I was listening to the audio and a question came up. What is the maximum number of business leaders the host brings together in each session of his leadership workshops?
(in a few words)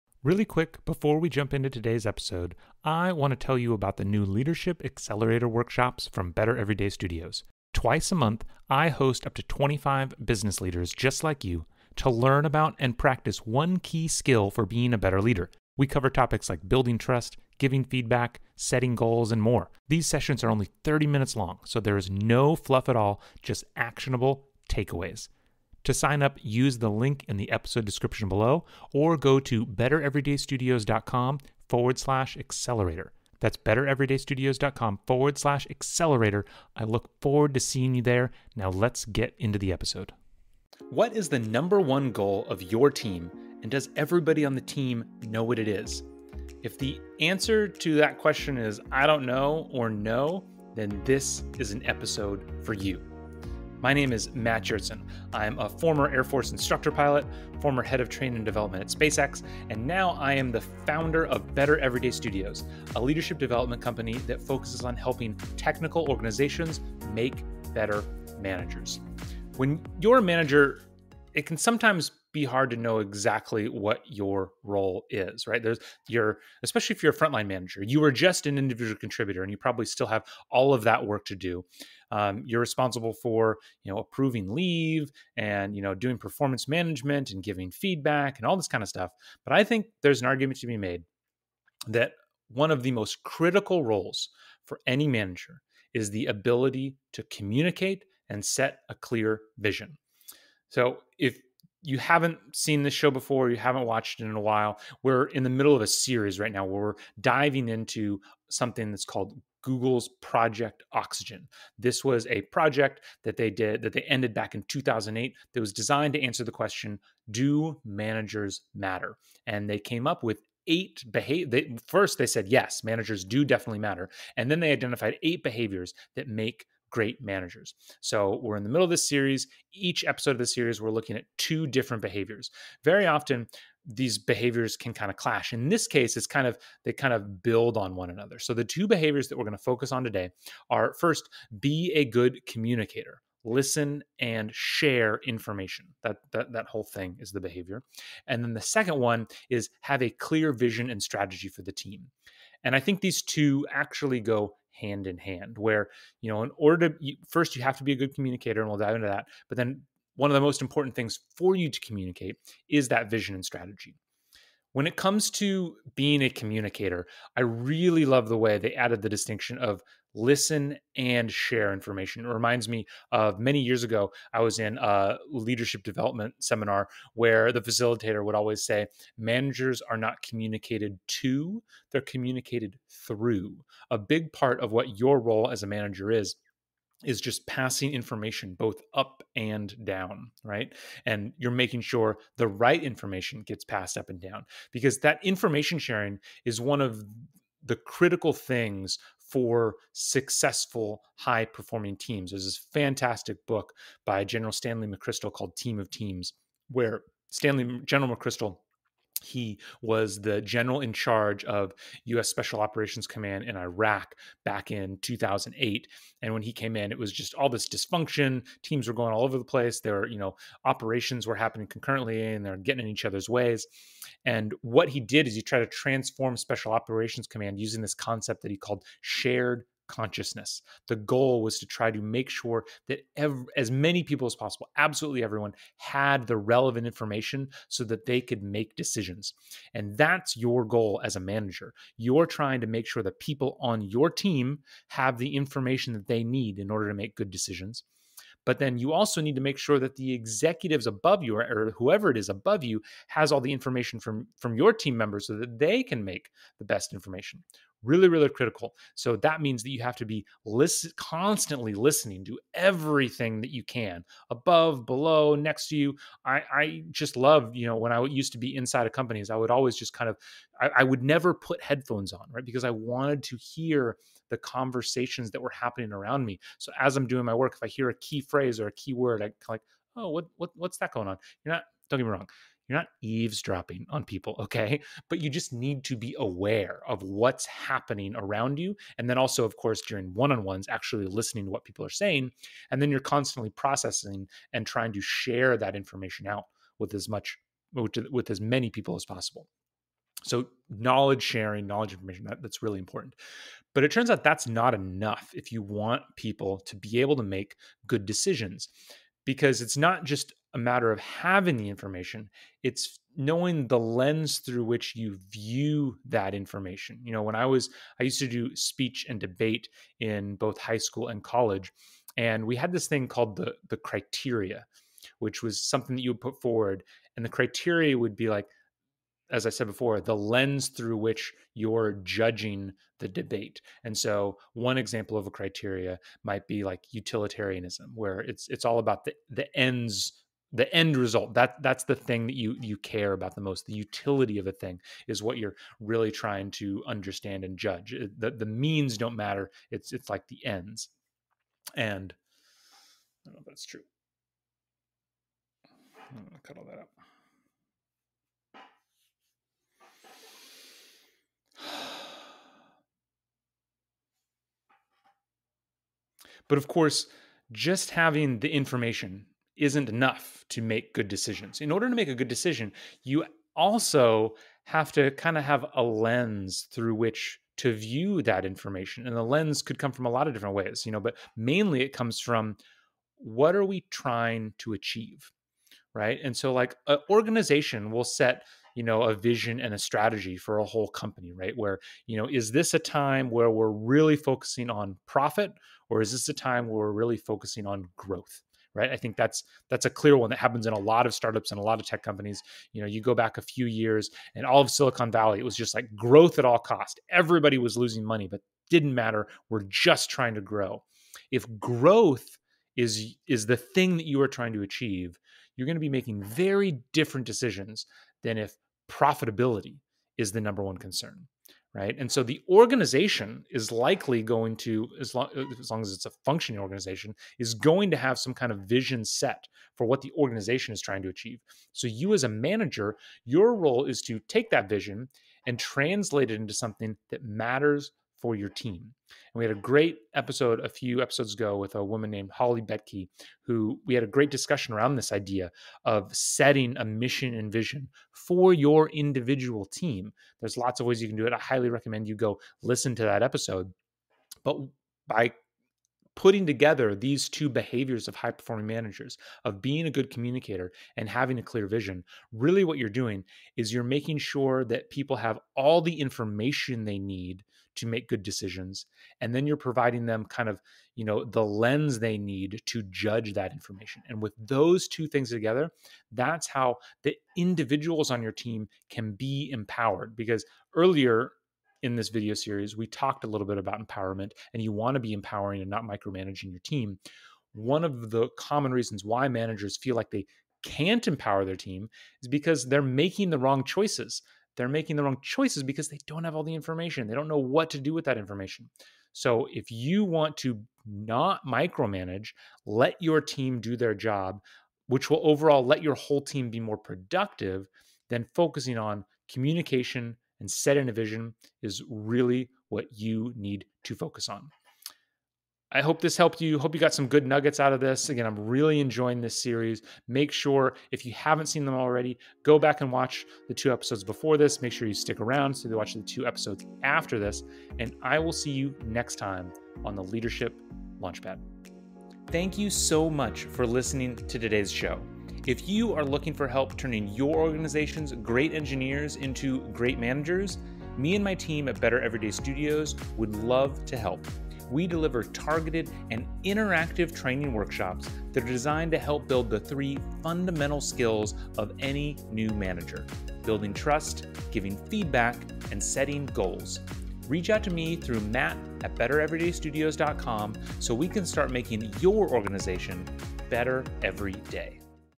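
25.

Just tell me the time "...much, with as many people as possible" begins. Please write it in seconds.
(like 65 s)
297 s.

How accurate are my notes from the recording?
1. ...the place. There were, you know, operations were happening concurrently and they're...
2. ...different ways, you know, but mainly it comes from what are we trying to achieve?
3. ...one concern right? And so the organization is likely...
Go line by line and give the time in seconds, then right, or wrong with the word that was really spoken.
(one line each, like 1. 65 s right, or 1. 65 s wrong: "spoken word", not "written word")
1. 219 s right
2. 380 s right
3. 420 s right.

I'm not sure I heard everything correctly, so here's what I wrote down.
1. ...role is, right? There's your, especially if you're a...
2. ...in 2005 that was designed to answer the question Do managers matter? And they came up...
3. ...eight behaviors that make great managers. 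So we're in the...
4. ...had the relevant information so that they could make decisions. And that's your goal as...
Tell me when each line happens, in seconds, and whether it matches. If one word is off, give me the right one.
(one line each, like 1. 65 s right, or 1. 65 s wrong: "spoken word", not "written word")
1. 74 s right
2. 114 s wrong: "2008", not "2005"
3. 125 s right
4. 235 s right.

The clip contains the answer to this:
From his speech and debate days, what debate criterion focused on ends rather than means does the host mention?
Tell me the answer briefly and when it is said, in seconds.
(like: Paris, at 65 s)
Utilitarianism, at 336 s.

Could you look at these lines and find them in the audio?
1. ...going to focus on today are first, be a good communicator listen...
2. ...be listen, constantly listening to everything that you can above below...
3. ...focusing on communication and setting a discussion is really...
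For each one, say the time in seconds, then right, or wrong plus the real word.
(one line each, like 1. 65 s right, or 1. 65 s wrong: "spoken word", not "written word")
1. 139 s right
2. 260 s right
3. 508 s wrong: "vision", not "discussion".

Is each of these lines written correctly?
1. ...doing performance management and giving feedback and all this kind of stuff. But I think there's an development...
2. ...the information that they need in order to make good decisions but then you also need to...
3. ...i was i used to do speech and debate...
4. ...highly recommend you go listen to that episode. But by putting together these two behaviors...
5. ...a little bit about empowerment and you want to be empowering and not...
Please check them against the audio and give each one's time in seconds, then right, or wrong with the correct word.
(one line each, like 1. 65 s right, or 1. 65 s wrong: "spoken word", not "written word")
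1. 85 s wrong: "argument", not "development"
2. 245 s right
3. 317 s right
4. 451 s right
5. 483 s right.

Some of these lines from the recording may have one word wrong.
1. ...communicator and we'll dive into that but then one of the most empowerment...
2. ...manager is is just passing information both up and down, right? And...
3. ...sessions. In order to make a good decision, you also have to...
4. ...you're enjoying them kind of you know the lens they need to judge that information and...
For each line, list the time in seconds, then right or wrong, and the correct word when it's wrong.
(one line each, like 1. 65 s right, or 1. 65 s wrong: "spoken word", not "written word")
1. 158 s wrong: "important", not "empowerment"
2. 185 s right
3. 371 s wrong: "decisions", not "sessions"
4. 469 s wrong: "providing", not "enjoying".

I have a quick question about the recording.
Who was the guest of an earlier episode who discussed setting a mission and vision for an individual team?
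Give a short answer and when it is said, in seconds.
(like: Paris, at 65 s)
Holly Betke, at 442 s.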